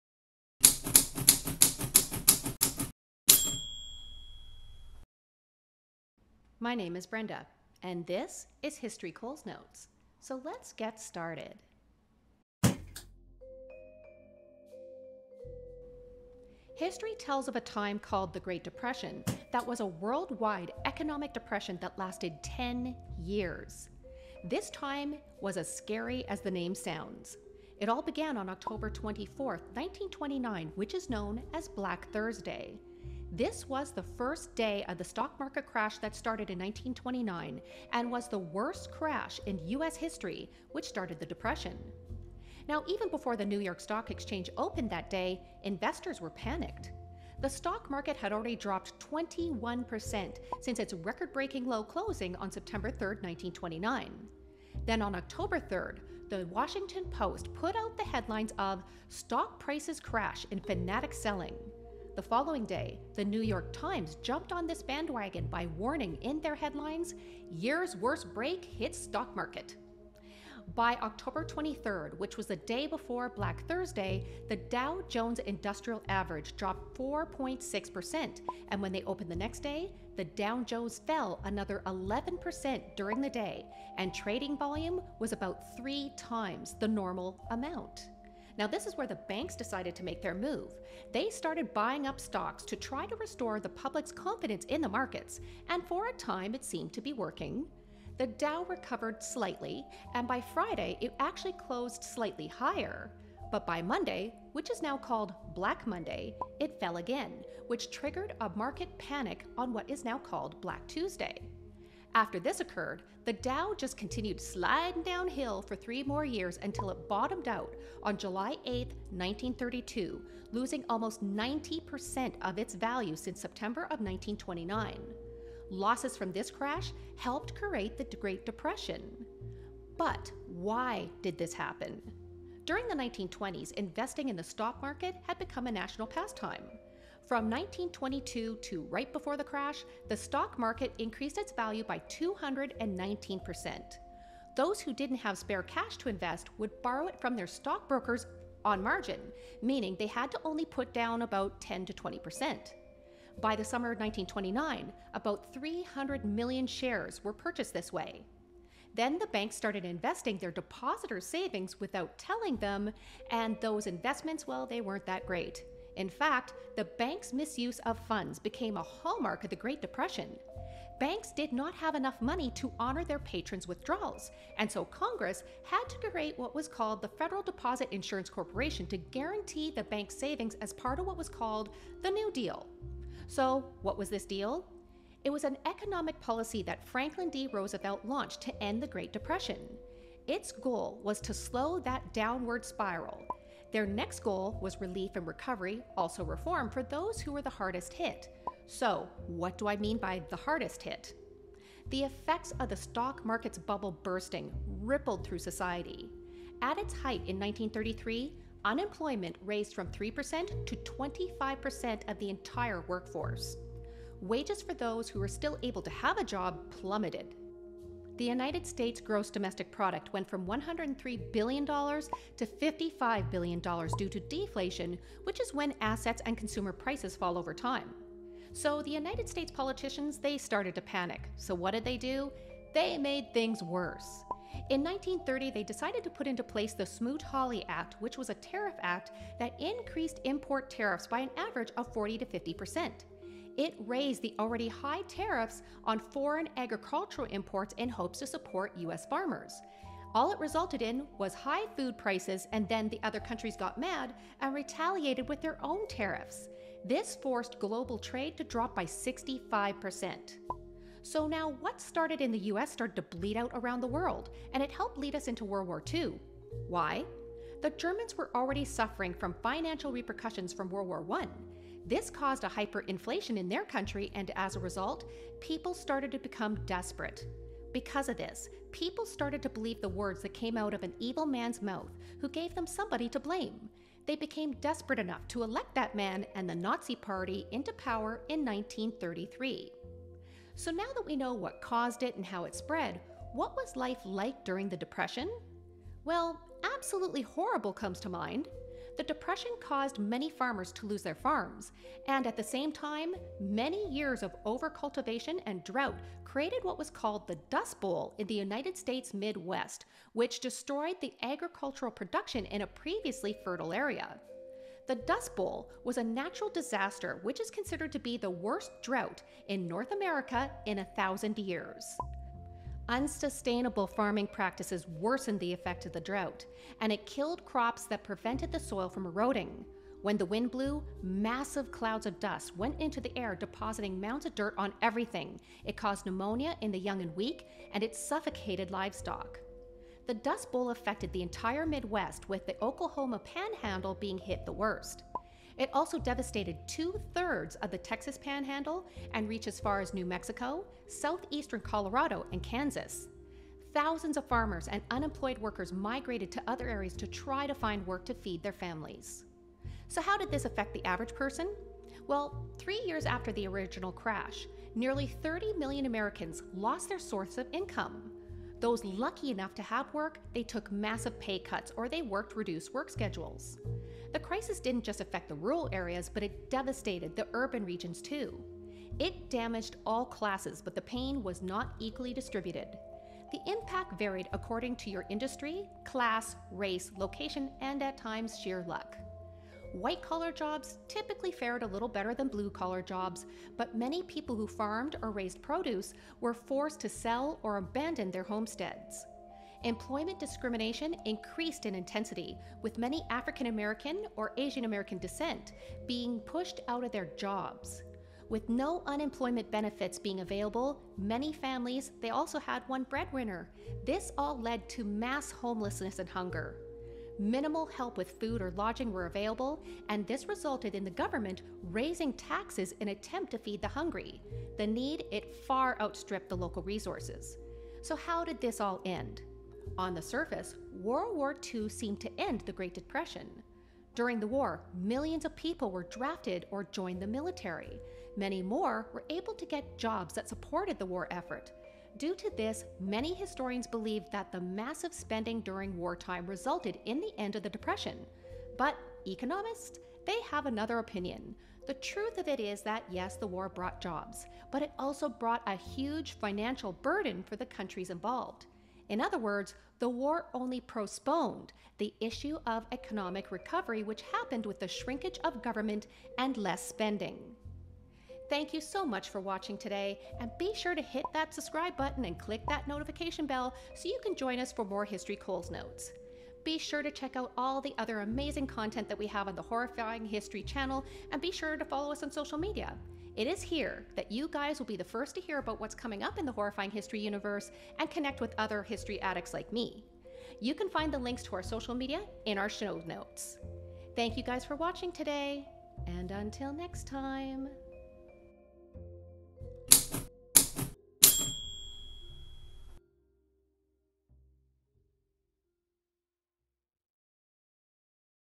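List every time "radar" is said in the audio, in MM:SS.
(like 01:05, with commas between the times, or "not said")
not said.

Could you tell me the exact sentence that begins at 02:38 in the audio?
Then the banks started investing their depositors' savings without telling them, and those investments, well, they weren't that great.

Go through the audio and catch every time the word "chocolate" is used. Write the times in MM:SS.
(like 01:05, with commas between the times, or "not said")
not said.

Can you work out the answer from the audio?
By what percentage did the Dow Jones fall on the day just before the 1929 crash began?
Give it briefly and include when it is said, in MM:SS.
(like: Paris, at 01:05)
4.6%, at 01:16.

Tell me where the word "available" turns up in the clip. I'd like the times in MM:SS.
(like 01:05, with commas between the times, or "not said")
06:50, 06:59.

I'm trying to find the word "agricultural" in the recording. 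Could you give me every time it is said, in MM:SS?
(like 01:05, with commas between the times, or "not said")
04:06, 05:11.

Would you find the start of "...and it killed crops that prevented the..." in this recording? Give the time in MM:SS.
05:26.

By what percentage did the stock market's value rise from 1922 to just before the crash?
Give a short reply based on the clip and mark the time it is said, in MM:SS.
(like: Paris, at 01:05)
219%, at 02:22.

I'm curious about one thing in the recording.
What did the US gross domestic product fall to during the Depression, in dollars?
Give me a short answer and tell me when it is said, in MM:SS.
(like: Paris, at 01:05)
$55 billion, at 03:42.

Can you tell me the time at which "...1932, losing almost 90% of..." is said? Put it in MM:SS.
01:59.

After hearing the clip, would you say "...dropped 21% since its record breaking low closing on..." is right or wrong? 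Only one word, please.
right.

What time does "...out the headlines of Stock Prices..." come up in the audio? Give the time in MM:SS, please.
00:57.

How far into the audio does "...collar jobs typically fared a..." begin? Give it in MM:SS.
06:30.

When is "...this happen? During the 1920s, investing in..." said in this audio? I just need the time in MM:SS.
02:11.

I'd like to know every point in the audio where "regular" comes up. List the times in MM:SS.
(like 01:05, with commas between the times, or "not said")
not said.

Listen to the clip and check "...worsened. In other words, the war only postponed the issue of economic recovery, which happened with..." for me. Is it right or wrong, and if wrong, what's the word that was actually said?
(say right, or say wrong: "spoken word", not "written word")
wrong: "involved", not "worsened".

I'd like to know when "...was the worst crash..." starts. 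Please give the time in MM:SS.
00:38.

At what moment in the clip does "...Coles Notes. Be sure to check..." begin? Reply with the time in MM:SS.
07:55.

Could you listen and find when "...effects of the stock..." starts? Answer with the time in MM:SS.
03:22.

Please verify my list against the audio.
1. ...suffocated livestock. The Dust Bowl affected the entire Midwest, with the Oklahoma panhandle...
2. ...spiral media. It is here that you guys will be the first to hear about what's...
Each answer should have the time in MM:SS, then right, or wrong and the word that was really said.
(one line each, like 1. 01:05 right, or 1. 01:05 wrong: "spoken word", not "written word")
1. 05:37 right
2. 08:02 wrong: "social", not "spiral".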